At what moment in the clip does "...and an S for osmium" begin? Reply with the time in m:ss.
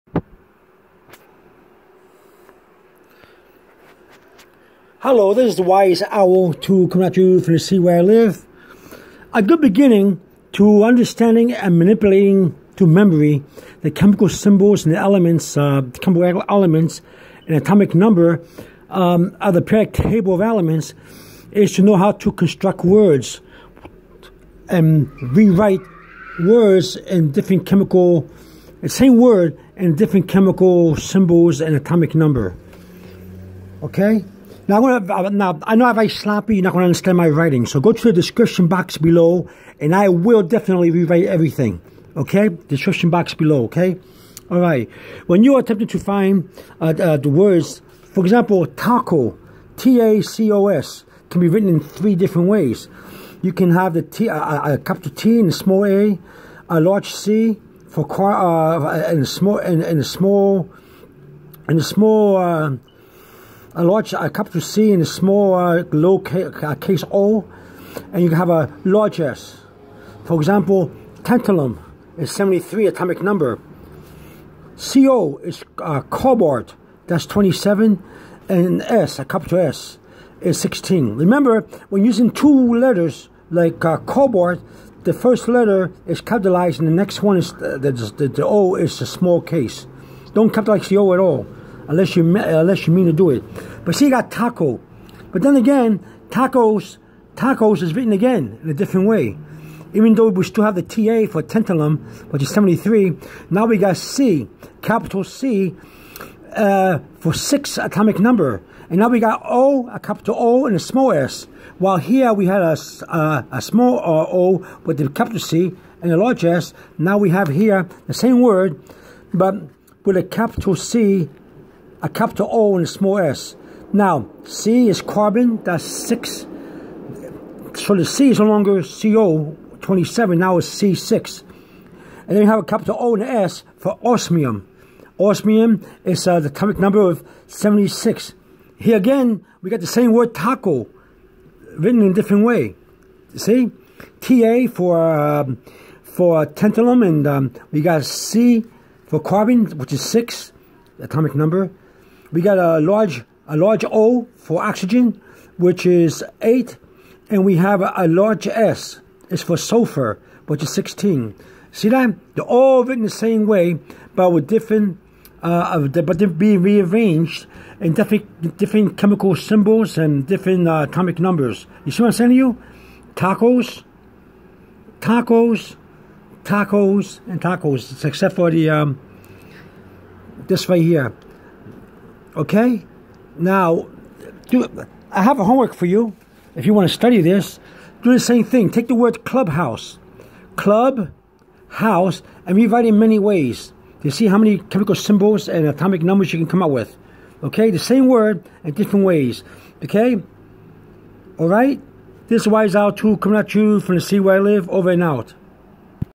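2:13.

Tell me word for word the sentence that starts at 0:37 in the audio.
So go to the description box below, and I will definitely rewrite everything.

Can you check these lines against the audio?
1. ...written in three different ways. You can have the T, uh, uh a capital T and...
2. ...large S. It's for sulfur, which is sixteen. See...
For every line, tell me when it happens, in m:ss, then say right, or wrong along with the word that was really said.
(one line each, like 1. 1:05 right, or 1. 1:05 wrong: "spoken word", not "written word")
1. 0:51 right
2. 2:38 right.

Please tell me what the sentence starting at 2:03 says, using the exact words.
Now, C is carbon, that's 6.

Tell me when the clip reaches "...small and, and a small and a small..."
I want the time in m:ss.
0:59.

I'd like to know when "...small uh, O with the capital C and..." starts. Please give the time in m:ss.
1:53.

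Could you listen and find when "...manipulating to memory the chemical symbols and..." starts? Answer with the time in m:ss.
0:11.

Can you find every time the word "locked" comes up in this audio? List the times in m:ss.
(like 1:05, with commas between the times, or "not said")
not said.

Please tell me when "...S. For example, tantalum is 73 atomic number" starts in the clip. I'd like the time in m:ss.
1:09.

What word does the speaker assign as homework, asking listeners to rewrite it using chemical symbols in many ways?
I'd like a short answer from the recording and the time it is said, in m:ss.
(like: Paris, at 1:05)
clubhouse, at 3:09.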